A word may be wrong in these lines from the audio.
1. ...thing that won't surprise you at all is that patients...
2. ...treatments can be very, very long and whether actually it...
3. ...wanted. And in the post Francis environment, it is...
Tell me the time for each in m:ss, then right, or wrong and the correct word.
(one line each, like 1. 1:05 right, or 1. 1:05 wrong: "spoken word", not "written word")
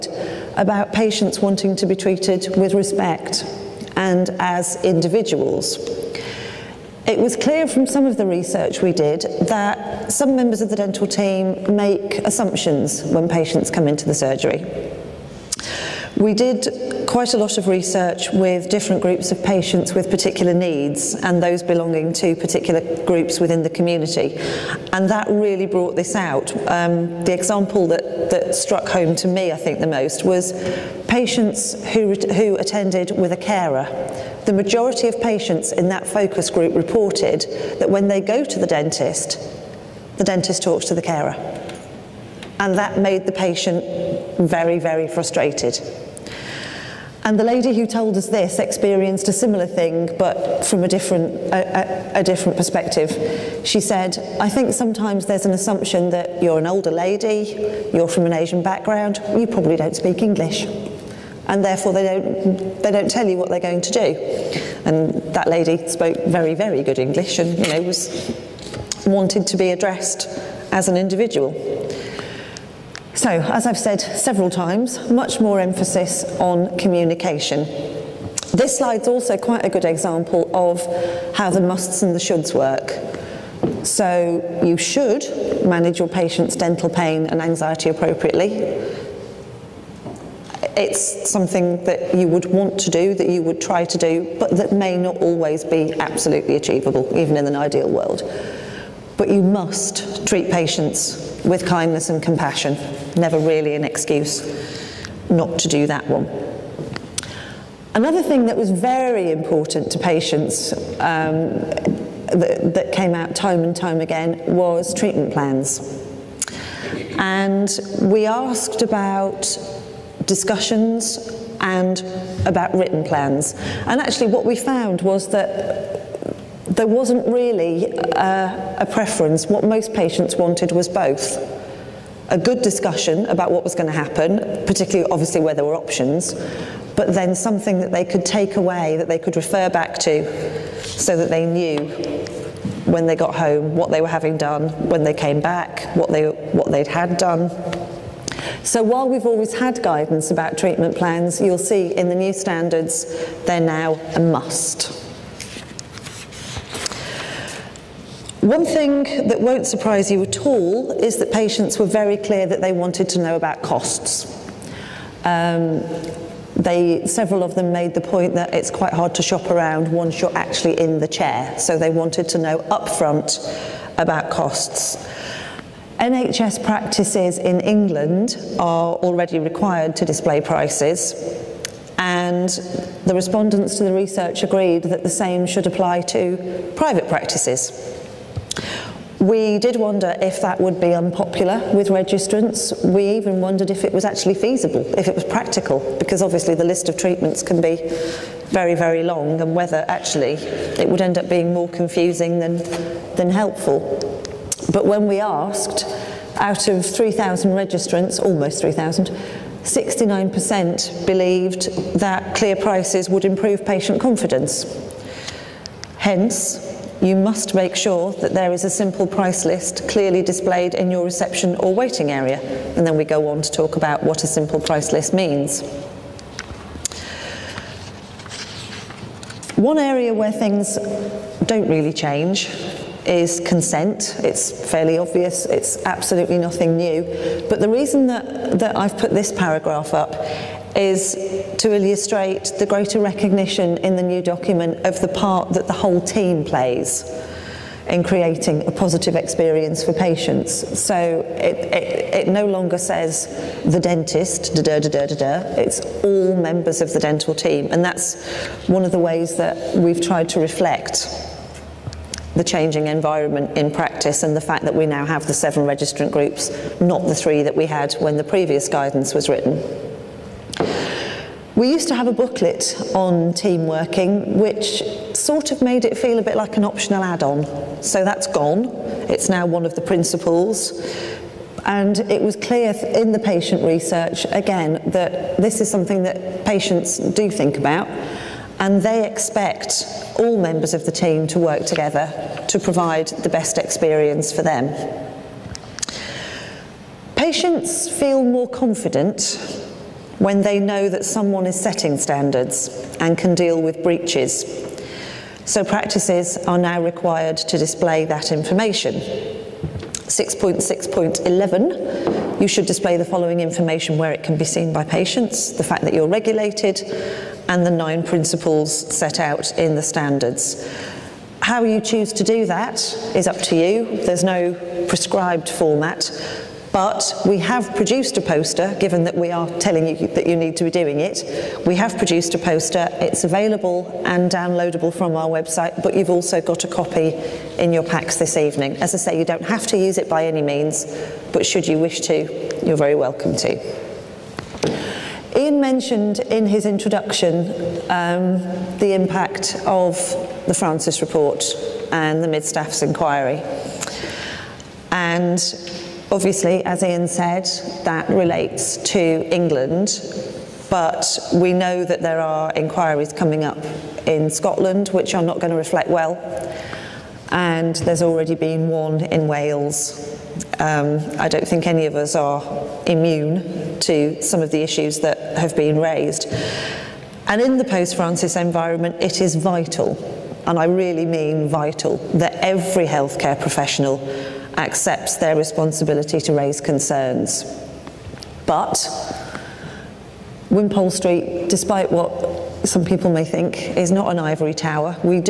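1. 2:38 right
2. 3:16 right
3. 6:15 wrong: "raised", not "wanted".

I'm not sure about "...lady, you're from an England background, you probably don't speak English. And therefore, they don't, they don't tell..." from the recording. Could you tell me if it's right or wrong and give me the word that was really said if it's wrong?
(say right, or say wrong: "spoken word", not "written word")
wrong: "Asian", not "England".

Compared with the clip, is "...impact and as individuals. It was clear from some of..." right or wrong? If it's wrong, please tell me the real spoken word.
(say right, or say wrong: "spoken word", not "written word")
wrong: "respect", not "impact".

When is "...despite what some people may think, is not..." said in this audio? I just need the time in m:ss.
6:31.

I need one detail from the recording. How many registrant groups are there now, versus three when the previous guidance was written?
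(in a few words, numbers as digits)
7.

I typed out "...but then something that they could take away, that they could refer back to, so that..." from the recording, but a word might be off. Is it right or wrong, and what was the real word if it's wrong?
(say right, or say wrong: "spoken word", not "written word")
right.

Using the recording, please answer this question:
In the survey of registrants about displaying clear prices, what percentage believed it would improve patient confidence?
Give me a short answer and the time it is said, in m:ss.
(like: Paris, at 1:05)
69%, at 3:29.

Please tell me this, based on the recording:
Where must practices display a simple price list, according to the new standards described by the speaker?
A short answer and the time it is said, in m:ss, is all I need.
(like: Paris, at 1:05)
Reception or waiting area, at 3:41.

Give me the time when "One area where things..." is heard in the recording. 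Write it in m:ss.
3:49.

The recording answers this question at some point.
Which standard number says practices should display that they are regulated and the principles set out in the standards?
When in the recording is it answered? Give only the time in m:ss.
5:09.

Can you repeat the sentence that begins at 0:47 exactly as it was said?
And the lady who told us this experienced a similar thing, but from a different, a, a, a, different perspective.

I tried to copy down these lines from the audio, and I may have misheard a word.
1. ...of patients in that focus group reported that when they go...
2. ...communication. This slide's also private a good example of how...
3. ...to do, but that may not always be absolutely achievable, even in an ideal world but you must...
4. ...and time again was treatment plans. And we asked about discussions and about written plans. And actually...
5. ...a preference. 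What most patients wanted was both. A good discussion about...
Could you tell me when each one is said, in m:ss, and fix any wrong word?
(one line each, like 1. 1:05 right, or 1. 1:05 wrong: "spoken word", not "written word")
1. 0:35 right
2. 1:16 wrong: "quite", not "private"
3. 1:33 right
4. 1:53 right
5. 2:08 right.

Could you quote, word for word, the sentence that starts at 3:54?
It's fairly obvious, it's absolutely nothing new.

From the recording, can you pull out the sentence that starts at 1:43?
Never really an excuse not to do that one.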